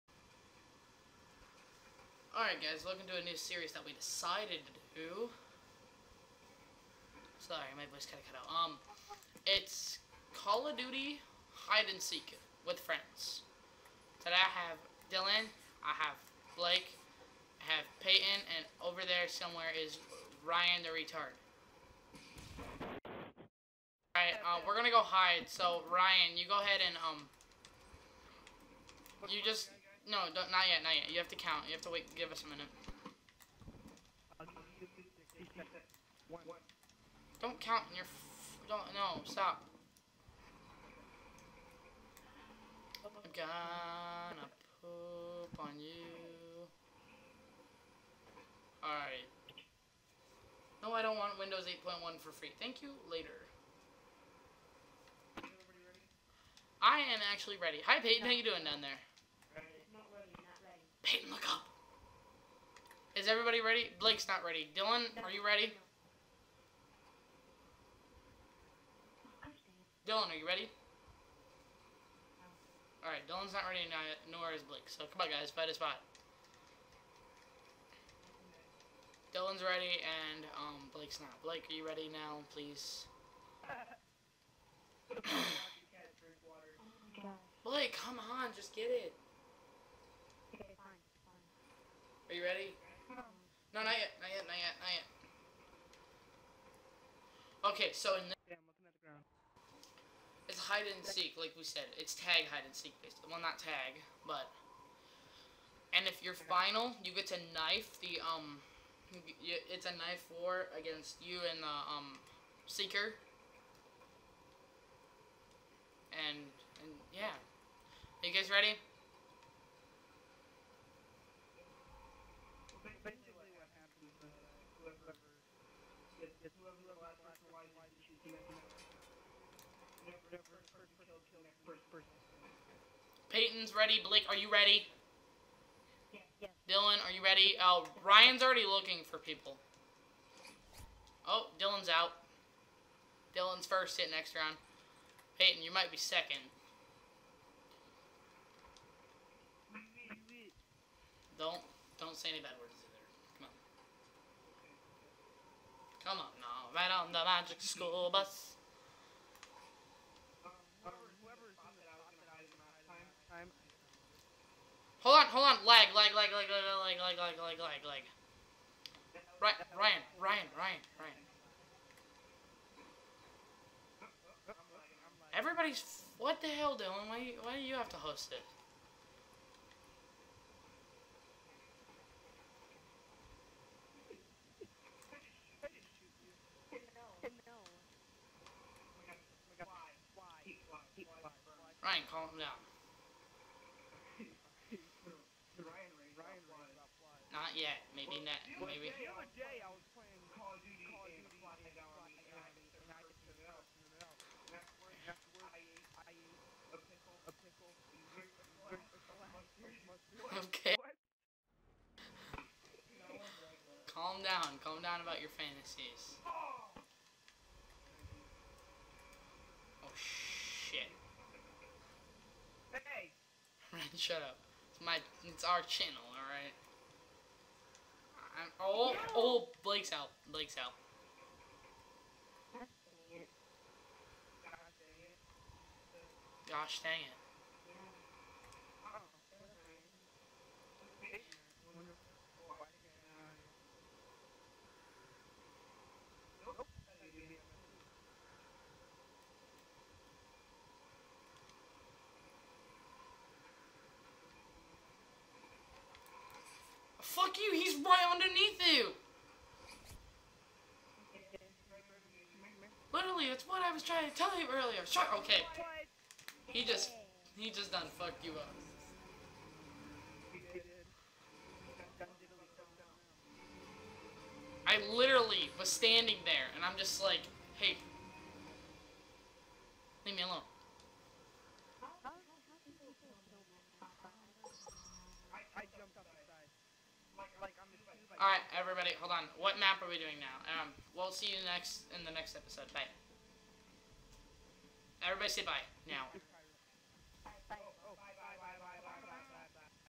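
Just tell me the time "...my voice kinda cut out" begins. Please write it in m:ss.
0:07.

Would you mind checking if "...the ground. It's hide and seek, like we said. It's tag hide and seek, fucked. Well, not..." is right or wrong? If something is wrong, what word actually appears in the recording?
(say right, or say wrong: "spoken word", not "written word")
wrong: "based", not "fucked".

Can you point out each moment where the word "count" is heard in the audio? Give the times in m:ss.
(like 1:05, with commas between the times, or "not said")
0:31, 0:37.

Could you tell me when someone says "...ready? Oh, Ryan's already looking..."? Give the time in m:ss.
2:17.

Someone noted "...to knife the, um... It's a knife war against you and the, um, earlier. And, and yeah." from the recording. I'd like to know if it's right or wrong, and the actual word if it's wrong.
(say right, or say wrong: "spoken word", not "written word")
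wrong: "seeker", not "earlier".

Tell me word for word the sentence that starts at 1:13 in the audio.
Alright, Dylan's not ready, nor is Blake.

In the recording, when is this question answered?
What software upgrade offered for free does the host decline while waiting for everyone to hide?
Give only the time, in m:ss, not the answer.
0:51.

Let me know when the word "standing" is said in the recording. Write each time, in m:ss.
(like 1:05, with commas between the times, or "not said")
4:35.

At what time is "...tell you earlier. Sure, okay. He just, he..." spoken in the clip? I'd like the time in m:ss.
4:24.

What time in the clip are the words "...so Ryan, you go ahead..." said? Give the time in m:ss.
0:25.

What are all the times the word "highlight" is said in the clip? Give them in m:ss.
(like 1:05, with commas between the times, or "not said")
not said.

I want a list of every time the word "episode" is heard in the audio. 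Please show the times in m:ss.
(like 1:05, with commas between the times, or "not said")
4:52.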